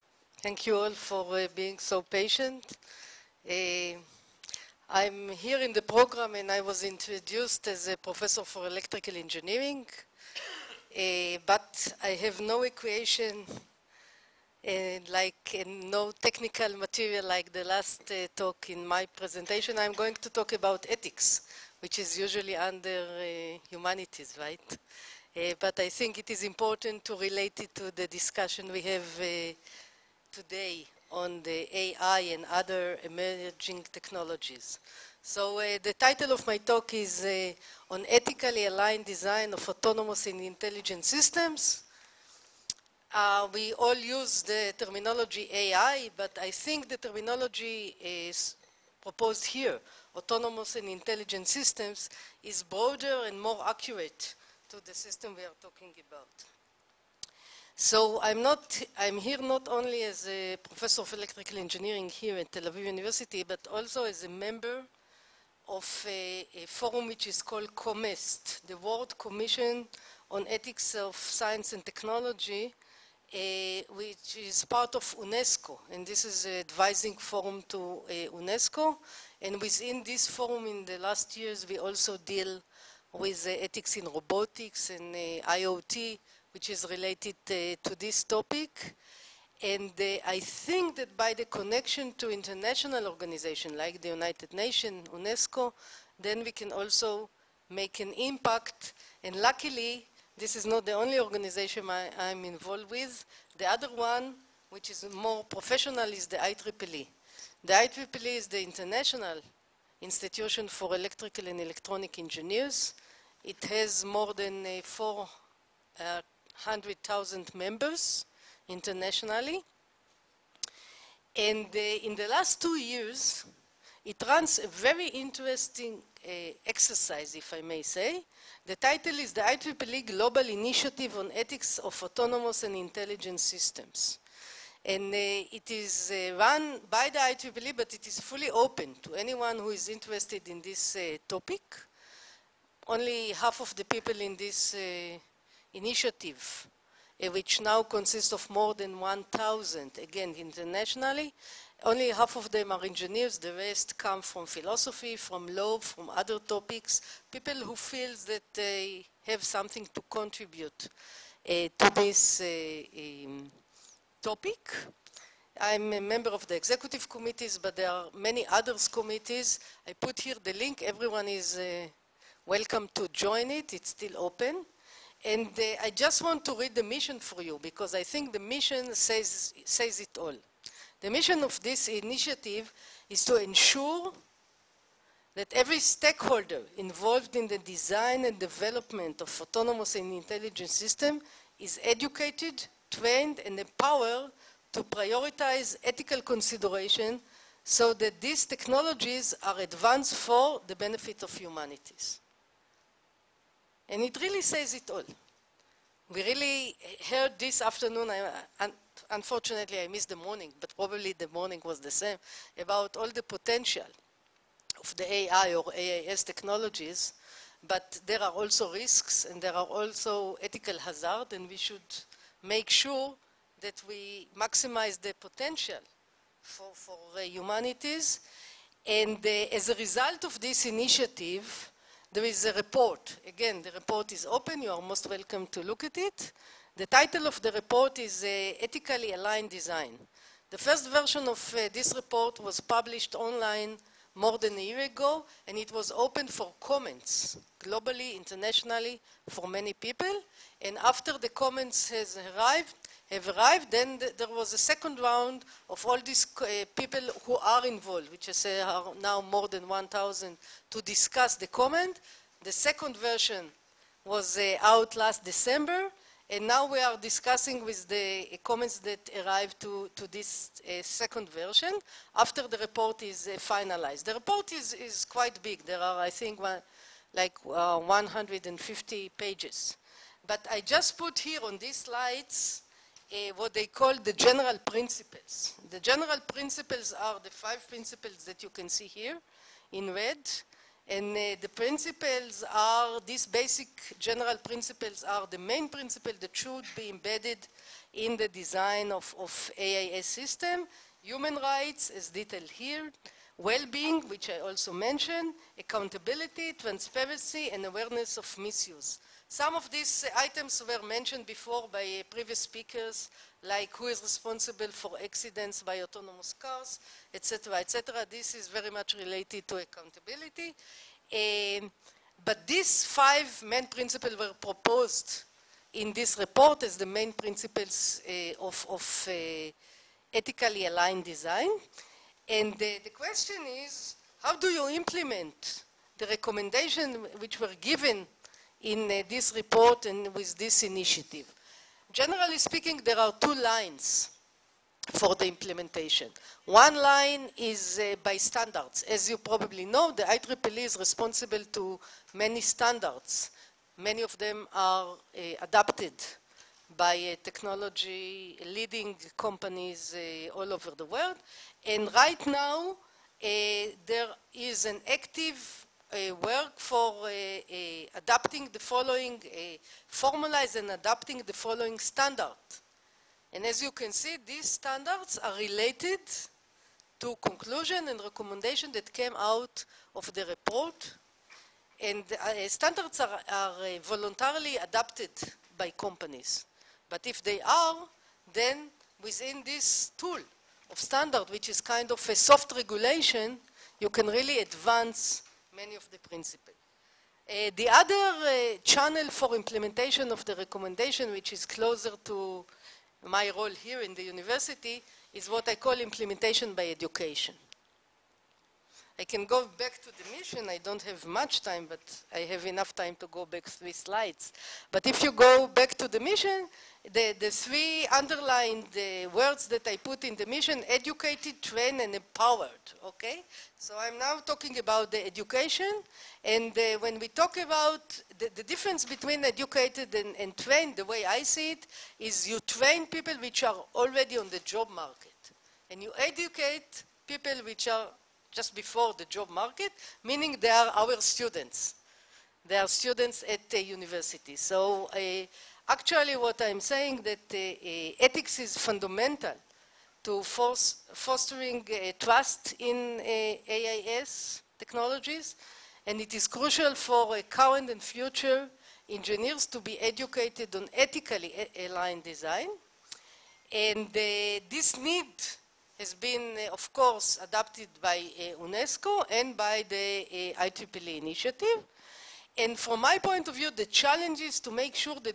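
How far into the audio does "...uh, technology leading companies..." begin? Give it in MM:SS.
05:57.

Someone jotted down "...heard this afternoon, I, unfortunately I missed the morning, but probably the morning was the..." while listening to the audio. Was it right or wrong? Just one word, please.
right.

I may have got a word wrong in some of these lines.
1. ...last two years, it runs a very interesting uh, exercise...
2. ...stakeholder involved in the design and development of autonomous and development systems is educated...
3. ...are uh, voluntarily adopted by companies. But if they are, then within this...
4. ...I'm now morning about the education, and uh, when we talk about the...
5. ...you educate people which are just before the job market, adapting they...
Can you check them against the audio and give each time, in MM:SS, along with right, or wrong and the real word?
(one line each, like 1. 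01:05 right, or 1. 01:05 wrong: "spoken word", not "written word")
1. 02:02 right
2. 03:05 wrong: "intelligent", not "development"
3. 06:23 right
4. 07:03 wrong: "talking", not "morning"
5. 07:15 wrong: "meaning", not "adapting".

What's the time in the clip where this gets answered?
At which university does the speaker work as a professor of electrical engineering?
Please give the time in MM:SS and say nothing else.
01:02.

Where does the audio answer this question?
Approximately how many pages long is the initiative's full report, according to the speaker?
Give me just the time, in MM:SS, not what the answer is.
04:37.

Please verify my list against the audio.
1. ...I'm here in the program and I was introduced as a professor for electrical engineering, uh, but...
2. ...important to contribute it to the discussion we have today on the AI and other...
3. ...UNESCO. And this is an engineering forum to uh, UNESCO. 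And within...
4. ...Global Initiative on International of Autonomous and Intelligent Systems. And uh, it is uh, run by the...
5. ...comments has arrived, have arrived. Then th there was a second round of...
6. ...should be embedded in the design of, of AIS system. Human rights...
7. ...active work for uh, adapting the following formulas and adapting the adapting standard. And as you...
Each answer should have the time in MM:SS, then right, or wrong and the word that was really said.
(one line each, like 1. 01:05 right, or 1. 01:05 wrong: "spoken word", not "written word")
1. 00:04 right
2. 00:26 wrong: "relate", not "contribute"
3. 01:15 wrong: "advising", not "engineering"
4. 02:10 wrong: "Ethics", not "International"
5. 04:11 right
6. 04:56 right
7. 06:04 wrong: "following", not "adapting".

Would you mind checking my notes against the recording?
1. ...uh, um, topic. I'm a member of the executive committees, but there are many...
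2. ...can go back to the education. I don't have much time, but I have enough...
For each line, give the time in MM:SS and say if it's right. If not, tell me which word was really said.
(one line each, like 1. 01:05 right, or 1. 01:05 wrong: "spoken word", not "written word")
1. 02:42 right
2. 06:49 wrong: "mission", not "education".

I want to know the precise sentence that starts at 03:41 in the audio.
and we should make sure that we maximize the potential for, for uh, humanities.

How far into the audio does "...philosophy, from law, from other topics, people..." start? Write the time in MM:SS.
02:34.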